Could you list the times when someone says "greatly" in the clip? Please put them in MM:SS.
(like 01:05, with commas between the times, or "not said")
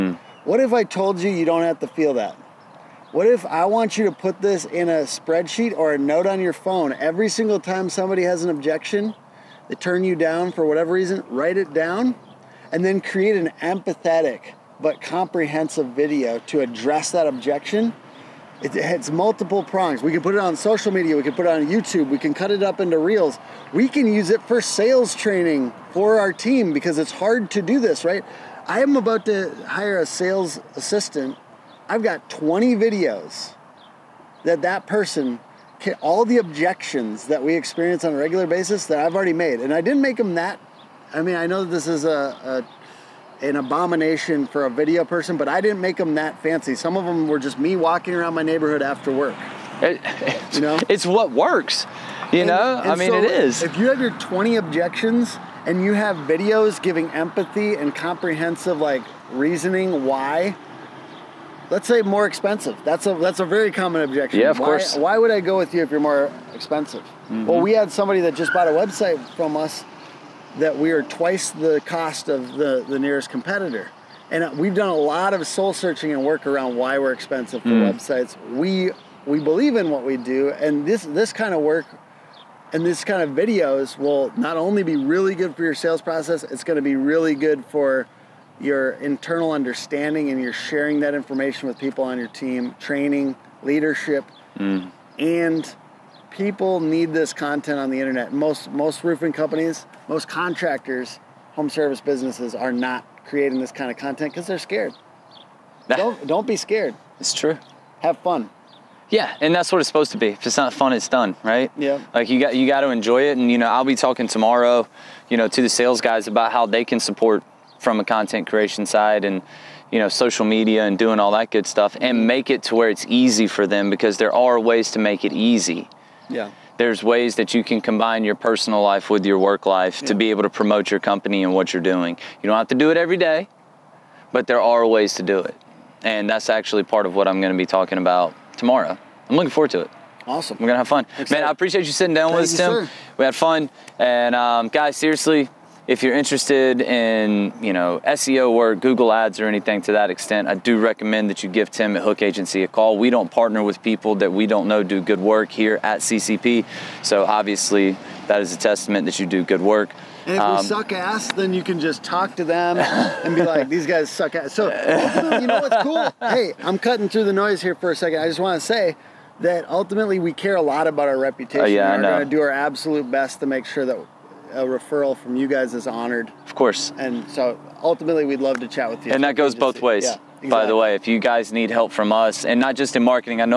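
not said.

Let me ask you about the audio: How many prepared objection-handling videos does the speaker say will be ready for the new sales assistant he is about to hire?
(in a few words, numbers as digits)
20.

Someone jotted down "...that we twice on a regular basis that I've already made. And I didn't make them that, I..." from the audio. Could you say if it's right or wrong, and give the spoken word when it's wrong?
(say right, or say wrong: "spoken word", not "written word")
wrong: "experience", not "twice".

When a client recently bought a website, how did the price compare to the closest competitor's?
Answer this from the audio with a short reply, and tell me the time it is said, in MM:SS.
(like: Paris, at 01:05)
Twice the cost, at 01:11.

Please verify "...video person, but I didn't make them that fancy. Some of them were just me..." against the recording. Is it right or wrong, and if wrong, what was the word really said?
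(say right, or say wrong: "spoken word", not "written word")
right.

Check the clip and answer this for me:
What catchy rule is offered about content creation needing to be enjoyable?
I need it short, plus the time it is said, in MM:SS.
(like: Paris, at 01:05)
If it's not fun, it's done, at 01:50.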